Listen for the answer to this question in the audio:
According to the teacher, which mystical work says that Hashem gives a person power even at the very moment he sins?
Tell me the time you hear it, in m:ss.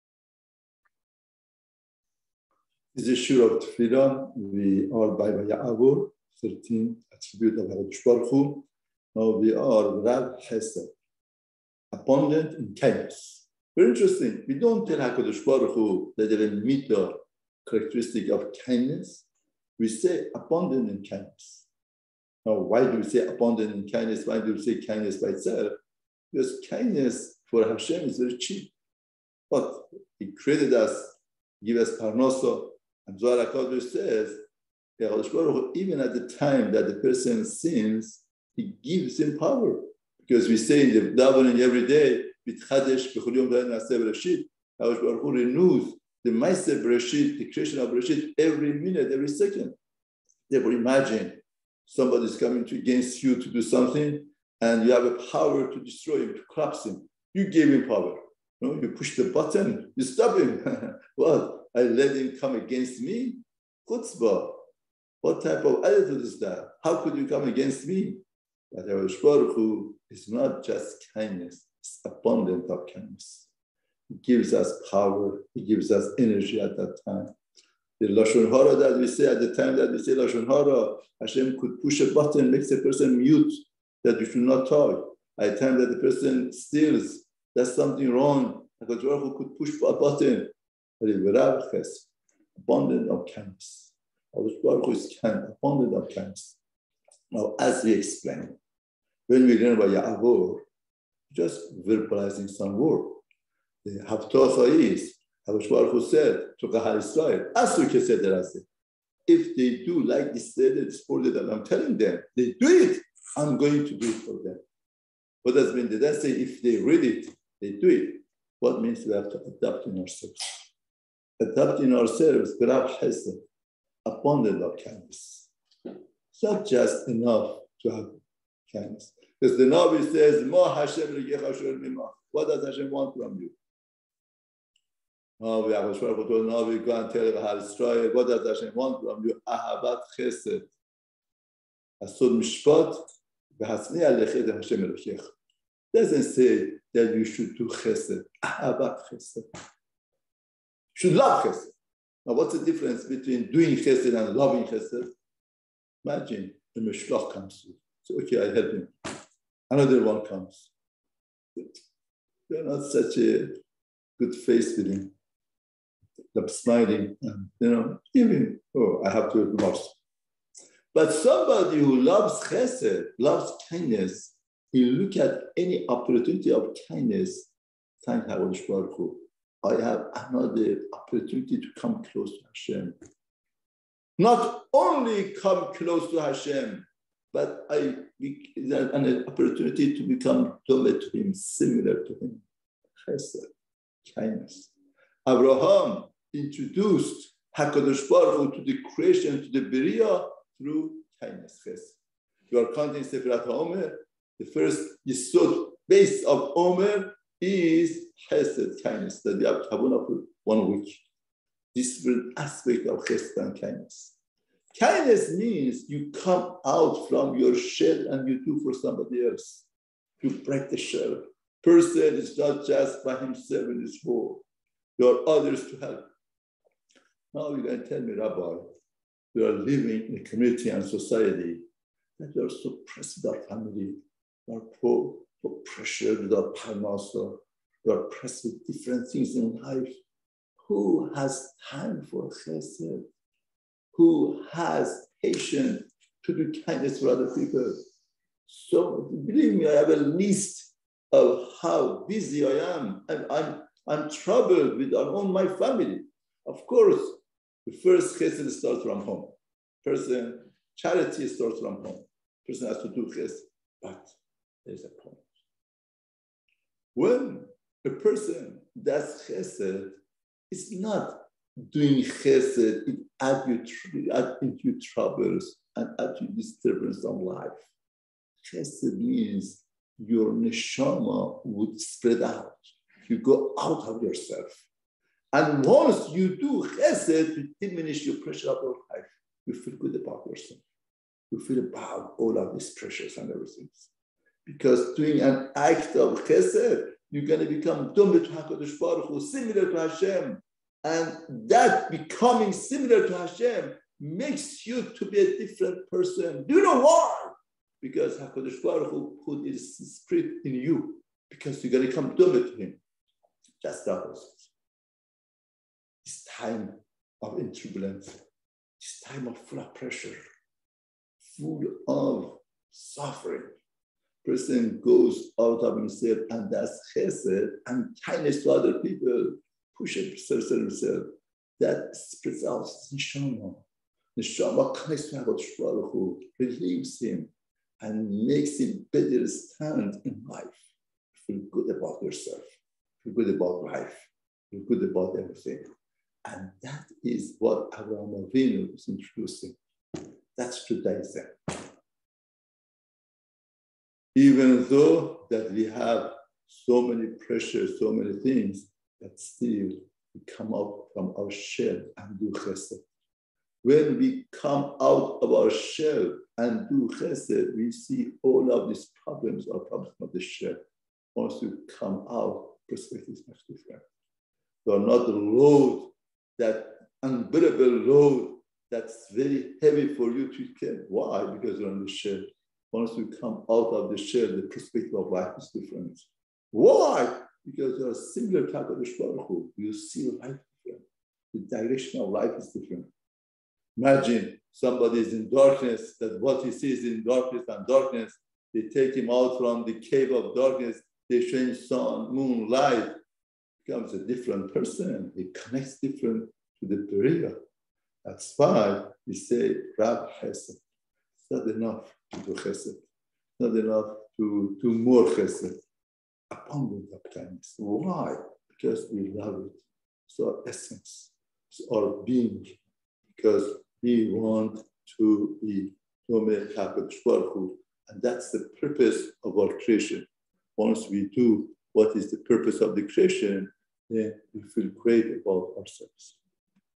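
0:33.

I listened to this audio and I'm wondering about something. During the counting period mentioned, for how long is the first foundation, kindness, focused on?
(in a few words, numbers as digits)
One week.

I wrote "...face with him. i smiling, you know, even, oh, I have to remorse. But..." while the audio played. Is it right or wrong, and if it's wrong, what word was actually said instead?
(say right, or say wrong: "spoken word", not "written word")
right.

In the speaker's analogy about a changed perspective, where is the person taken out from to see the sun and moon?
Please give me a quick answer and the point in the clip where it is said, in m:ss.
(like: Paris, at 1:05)
Cave of darkness, at 6:39.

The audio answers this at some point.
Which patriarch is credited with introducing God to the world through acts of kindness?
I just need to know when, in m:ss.
3:15.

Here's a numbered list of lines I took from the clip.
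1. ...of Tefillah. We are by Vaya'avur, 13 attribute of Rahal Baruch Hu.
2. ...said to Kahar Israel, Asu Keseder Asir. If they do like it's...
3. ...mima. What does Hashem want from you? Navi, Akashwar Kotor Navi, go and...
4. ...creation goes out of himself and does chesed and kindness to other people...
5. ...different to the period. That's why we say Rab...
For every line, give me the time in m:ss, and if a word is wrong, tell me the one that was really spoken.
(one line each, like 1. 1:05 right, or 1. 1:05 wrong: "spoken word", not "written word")
1. 0:03 wrong: "HaKadosh", not "Rahal"
2. 1:46 right
3. 2:11 right
4. 5:24 wrong: "person", not "creation"
5. 6:45 right.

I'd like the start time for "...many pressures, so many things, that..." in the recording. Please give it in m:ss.
5:56.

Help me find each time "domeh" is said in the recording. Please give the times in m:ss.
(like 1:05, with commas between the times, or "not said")
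4:57, 5:12.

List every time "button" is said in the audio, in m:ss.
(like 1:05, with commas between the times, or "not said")
0:59, 1:22, 1:29.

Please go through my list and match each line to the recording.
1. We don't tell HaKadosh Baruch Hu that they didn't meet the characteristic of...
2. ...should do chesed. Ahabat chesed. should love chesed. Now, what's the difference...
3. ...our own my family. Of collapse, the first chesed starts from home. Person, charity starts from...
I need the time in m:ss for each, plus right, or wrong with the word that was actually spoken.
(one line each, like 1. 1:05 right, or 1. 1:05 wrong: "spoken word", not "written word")
1. 0:14 right
2. 2:27 right
3. 4:14 wrong: "course", not "collapse".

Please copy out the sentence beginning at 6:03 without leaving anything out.
When we come out of our shell and do chesed, we see all of these problems are problems of the shell.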